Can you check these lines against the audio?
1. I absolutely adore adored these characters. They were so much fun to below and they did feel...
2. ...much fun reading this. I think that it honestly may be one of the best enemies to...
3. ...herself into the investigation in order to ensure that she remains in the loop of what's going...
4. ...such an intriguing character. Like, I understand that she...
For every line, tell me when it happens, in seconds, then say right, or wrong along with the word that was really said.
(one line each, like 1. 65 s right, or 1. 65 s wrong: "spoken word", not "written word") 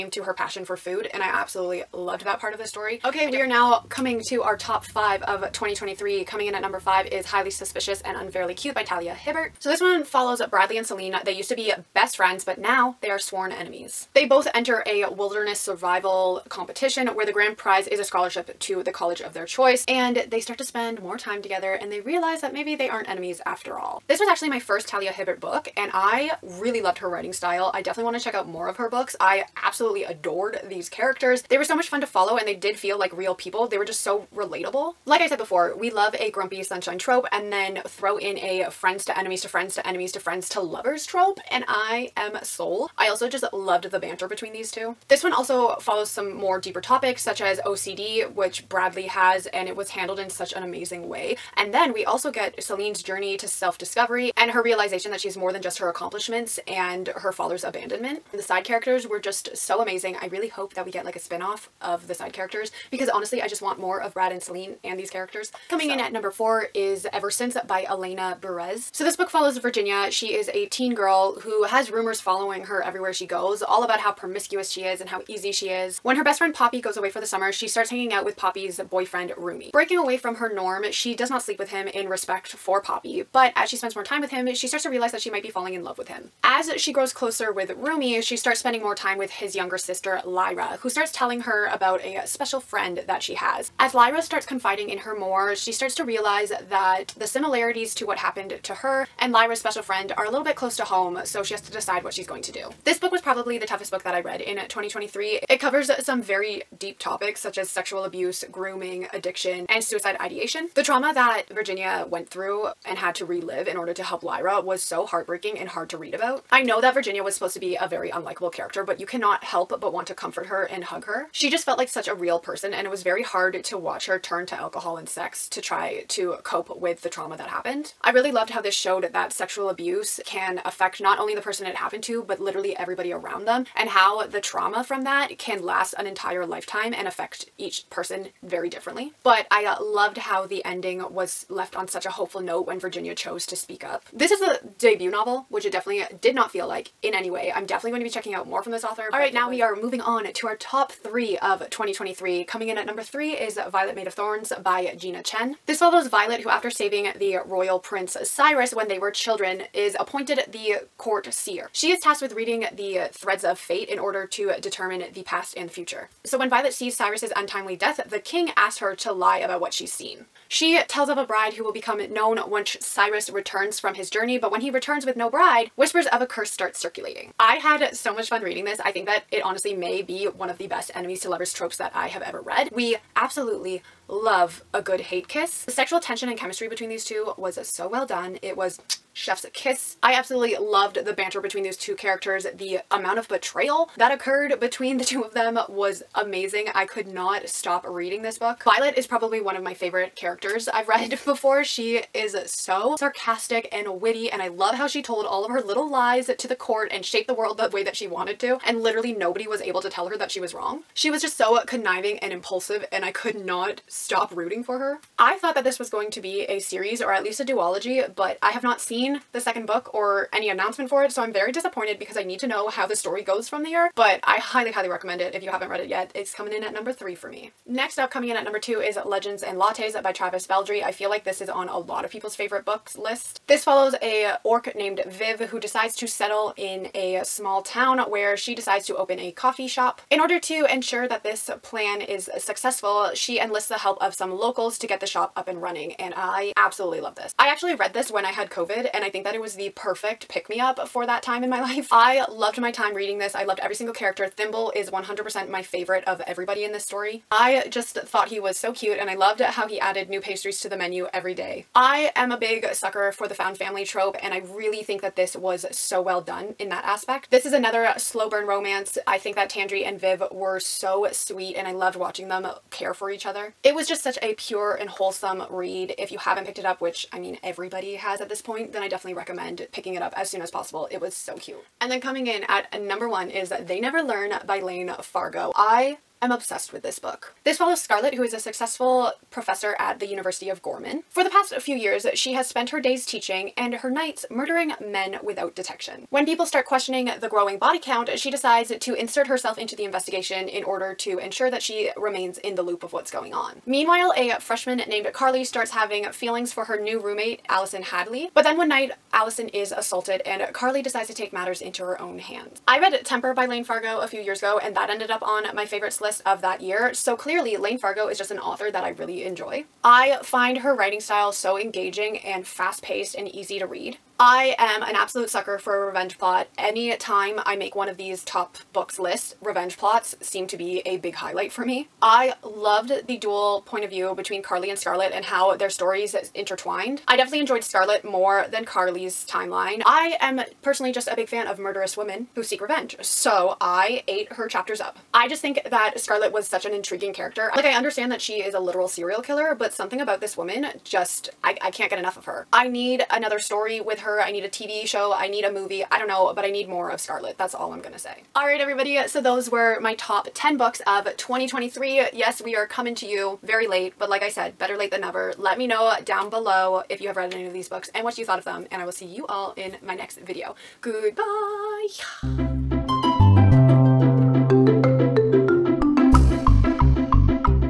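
1. 29 s wrong: "follow", not "below"
2. 178 s right
3. 299 s right
4. 346 s right.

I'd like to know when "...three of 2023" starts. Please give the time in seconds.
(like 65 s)
150 s.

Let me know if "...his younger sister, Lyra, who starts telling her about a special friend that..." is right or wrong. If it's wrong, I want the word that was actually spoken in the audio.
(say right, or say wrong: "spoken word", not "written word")
right.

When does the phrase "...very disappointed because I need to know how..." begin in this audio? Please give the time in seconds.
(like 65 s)
221 s.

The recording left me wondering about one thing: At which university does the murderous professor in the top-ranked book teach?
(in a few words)
University of Gorman.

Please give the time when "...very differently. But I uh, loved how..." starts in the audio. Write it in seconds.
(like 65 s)
138 s.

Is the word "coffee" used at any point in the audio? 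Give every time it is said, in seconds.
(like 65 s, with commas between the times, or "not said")
239 s.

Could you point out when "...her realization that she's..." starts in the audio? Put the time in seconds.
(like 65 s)
54 s.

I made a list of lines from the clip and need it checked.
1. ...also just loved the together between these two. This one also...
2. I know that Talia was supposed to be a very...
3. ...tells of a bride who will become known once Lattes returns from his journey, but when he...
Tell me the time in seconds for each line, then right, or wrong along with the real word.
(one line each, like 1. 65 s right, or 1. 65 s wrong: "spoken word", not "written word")
1. 43 s wrong: "banter", not "together"
2. 116 s wrong: "Virginia", not "Talia"
3. 170 s wrong: "Cyrus", not "Lattes".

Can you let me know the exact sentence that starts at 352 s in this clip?
I need another story with her.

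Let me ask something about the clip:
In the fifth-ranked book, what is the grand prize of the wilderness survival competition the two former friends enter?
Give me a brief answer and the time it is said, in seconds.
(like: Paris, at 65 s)
A scholarship, at 18 s.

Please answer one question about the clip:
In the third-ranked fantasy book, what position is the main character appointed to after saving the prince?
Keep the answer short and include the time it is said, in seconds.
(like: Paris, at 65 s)
Court seer, at 160 s.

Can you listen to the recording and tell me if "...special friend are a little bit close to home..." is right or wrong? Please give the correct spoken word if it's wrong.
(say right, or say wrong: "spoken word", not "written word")
right.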